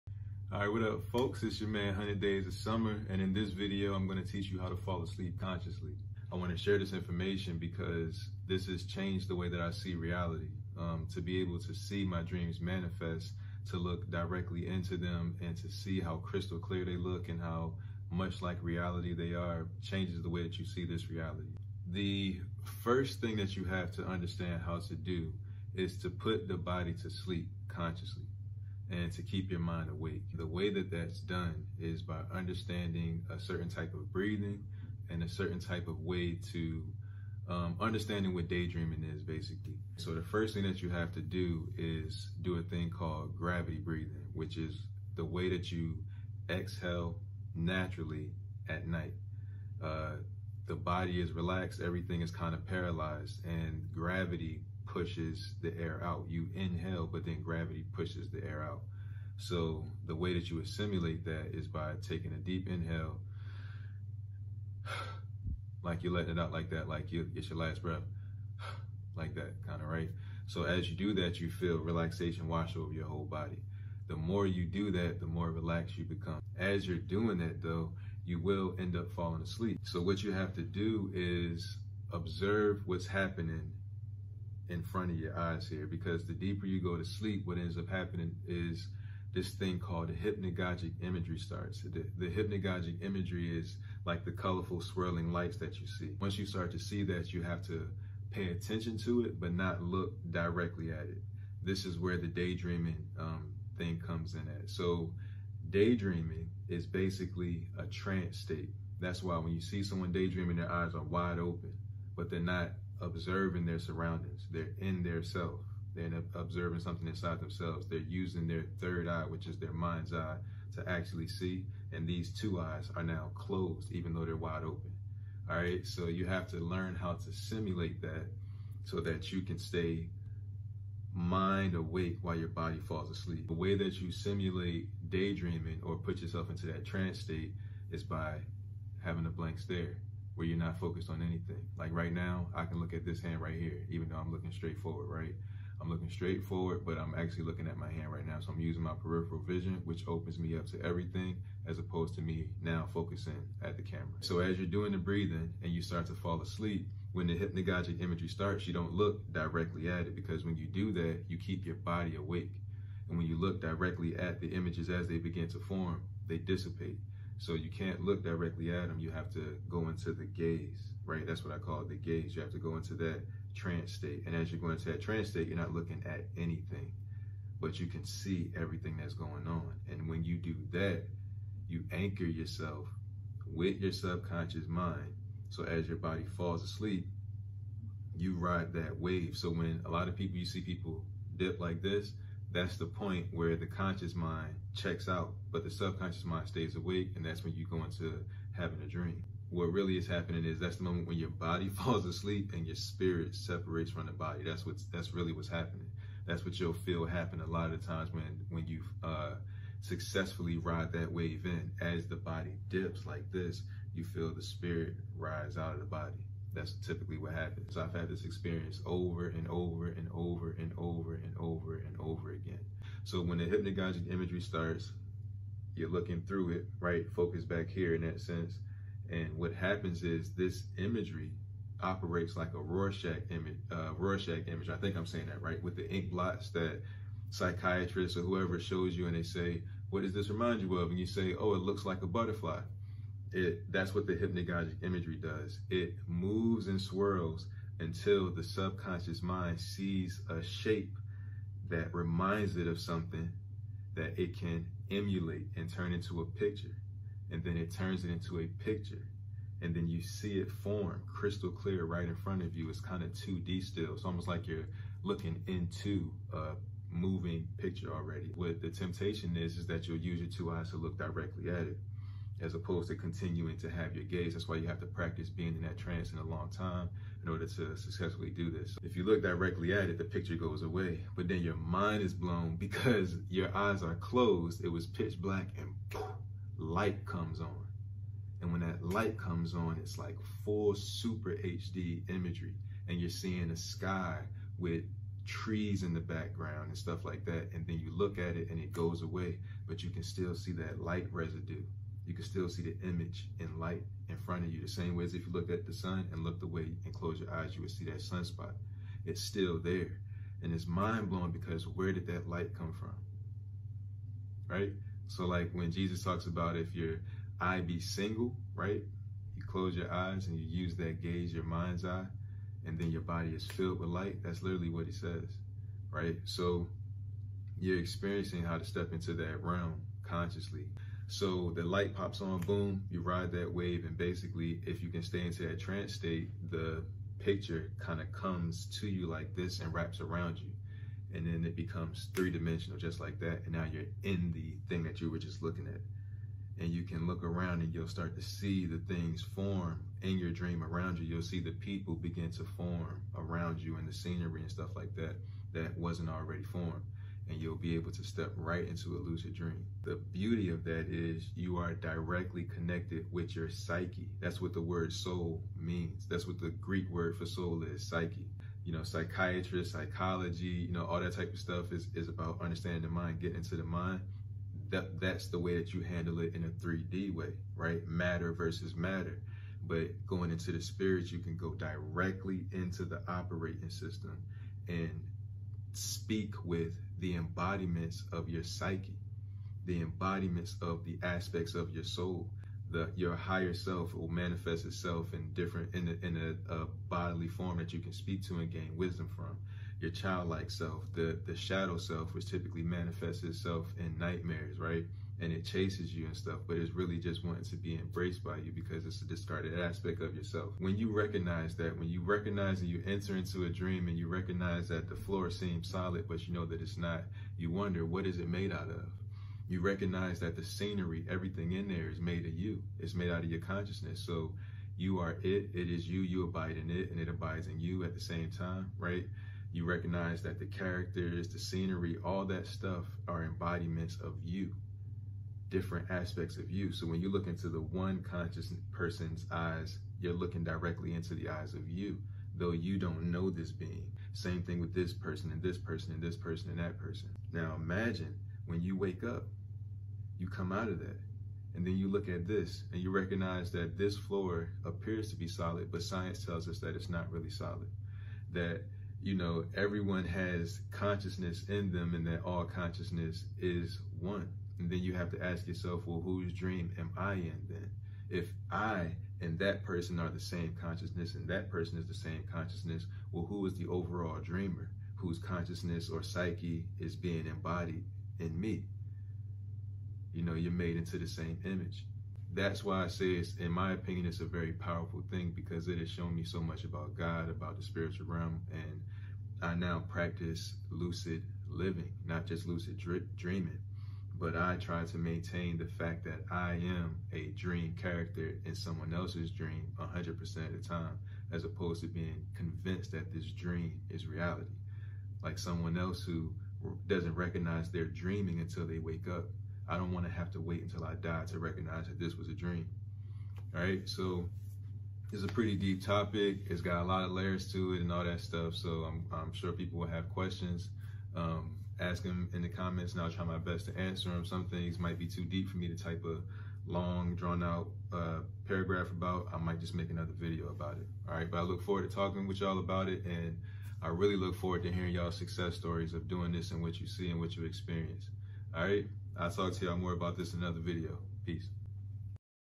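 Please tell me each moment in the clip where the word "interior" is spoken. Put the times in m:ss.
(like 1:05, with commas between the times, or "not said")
not said.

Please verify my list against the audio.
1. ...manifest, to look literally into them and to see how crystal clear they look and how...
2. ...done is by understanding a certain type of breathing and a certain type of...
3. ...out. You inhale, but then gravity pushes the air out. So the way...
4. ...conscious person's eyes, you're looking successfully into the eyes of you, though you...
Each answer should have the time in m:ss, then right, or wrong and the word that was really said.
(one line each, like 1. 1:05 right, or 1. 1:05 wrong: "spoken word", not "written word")
1. 0:12 wrong: "directly", not "literally"
2. 0:31 right
3. 0:56 right
4. 7:18 wrong: "directly", not "successfully".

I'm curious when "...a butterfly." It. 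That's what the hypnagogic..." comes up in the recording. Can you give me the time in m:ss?
4:02.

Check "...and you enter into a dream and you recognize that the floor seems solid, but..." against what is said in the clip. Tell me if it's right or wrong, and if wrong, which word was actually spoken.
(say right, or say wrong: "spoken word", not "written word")
right.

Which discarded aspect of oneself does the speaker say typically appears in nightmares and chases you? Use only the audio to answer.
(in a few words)
shadow self.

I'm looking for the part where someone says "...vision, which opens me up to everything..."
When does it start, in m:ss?
2:29.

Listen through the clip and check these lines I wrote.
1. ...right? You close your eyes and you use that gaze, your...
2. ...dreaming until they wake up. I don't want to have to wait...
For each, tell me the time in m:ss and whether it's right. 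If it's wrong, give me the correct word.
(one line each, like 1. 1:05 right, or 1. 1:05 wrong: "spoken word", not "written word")
1. 5:18 right
2. 8:27 right.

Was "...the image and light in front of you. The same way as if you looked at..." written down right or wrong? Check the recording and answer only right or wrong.
right.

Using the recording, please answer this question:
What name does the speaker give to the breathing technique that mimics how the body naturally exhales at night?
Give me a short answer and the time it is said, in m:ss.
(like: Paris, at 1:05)
gravity breathing, at 0:43.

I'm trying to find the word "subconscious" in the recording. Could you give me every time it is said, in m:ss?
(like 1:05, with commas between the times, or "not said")
3:03, 3:15, 4:08.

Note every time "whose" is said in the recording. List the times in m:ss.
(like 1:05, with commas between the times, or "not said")
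7:46, 7:54.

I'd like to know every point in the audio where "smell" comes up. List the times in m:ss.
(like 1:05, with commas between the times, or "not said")
not said.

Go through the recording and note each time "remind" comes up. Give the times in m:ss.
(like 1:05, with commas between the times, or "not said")
4:00, 4:11.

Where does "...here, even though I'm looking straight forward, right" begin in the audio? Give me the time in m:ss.
2:23.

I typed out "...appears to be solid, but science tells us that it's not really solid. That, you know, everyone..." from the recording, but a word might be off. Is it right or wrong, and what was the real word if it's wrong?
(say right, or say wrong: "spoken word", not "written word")
right.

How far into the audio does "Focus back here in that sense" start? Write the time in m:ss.
3:47.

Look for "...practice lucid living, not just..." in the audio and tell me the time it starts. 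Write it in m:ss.
8:09.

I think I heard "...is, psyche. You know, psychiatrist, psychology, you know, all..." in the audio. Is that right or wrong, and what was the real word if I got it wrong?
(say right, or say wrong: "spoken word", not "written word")
right.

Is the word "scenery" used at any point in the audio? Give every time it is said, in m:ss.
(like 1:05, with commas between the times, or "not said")
5:53, 7:00, 7:11.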